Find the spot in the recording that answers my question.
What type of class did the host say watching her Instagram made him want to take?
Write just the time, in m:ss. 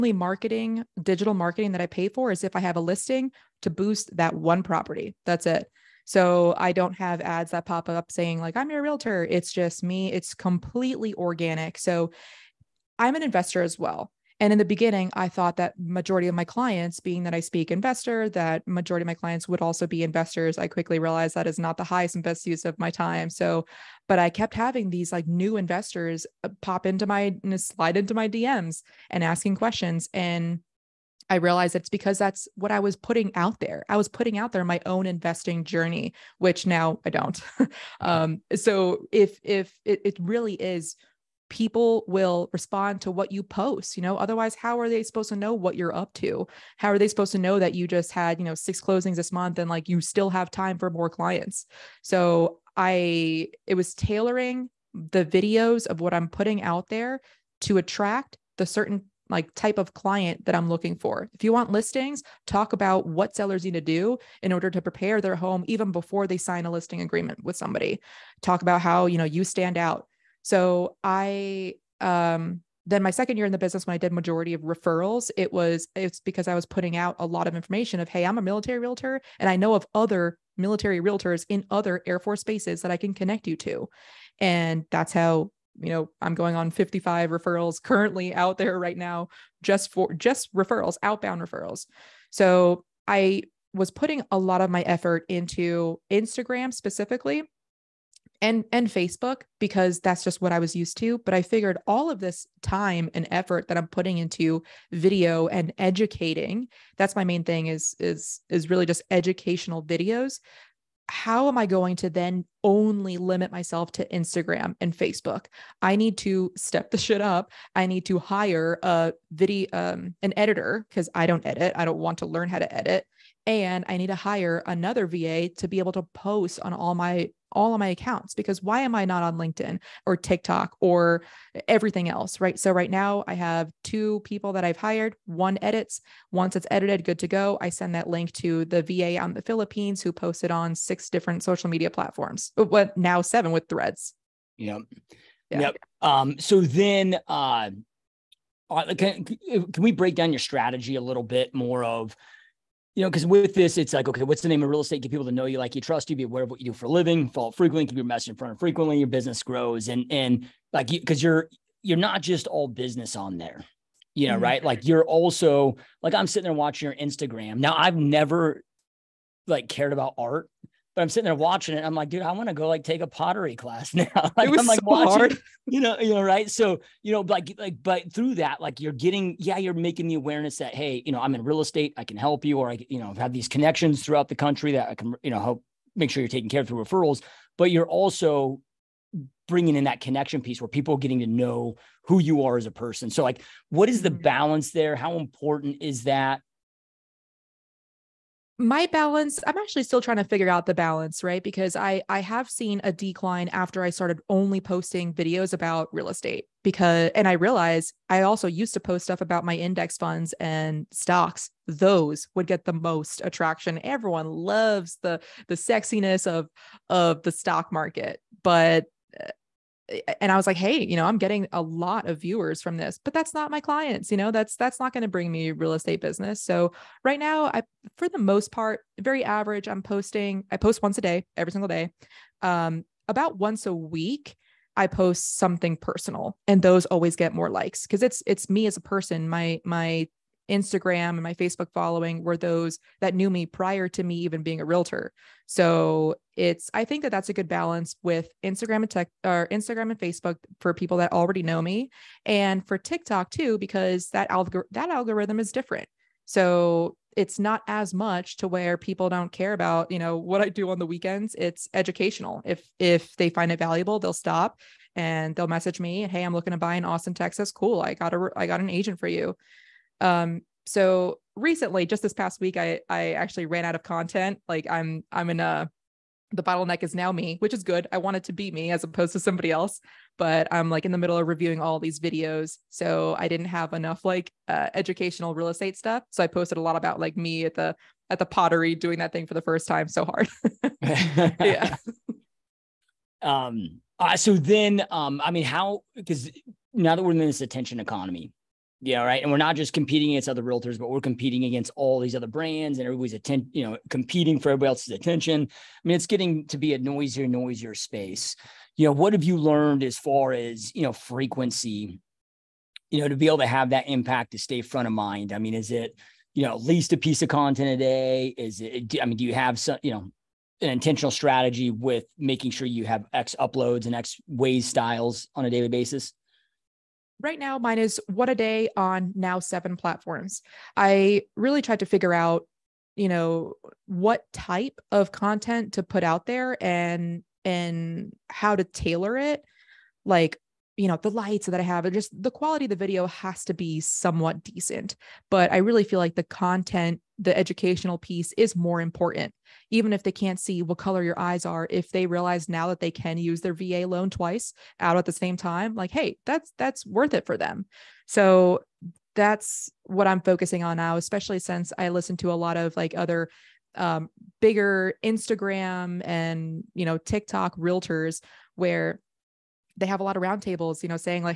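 2:53.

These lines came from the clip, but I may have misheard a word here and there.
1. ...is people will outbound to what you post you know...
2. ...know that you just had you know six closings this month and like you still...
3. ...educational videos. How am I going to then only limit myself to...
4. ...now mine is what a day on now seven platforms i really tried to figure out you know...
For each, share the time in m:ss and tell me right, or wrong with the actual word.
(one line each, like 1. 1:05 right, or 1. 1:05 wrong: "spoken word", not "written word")
1. 0:40 wrong: "respond", not "outbound"
2. 0:47 right
3. 1:49 right
4. 5:27 right.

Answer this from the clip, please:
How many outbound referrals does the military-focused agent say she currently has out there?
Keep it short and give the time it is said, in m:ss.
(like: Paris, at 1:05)
55, at 1:26.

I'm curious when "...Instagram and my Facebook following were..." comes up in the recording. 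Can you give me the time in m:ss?
4:00.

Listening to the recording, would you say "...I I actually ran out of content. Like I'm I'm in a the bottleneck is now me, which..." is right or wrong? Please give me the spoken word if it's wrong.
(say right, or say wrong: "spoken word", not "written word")
right.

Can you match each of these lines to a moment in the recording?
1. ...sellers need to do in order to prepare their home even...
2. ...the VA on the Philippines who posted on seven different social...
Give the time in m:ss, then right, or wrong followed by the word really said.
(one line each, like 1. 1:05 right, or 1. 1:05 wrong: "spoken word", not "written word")
1. 1:03 right
2. 2:18 wrong: "six", not "seven".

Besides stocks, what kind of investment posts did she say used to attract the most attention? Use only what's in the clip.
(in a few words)
index funds.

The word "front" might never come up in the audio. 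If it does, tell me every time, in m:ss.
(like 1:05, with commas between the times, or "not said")
2:38, 5:14.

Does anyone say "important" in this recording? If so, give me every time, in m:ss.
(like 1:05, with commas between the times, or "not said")
3:15, 5:48.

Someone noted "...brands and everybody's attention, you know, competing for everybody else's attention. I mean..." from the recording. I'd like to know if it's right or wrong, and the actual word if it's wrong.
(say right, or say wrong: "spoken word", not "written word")
right.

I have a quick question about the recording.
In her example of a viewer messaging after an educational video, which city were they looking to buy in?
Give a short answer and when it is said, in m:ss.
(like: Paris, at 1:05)
Austin, Texas, at 4:26.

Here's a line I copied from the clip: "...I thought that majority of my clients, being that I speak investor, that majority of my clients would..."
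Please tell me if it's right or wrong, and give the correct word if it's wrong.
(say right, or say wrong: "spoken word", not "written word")
right.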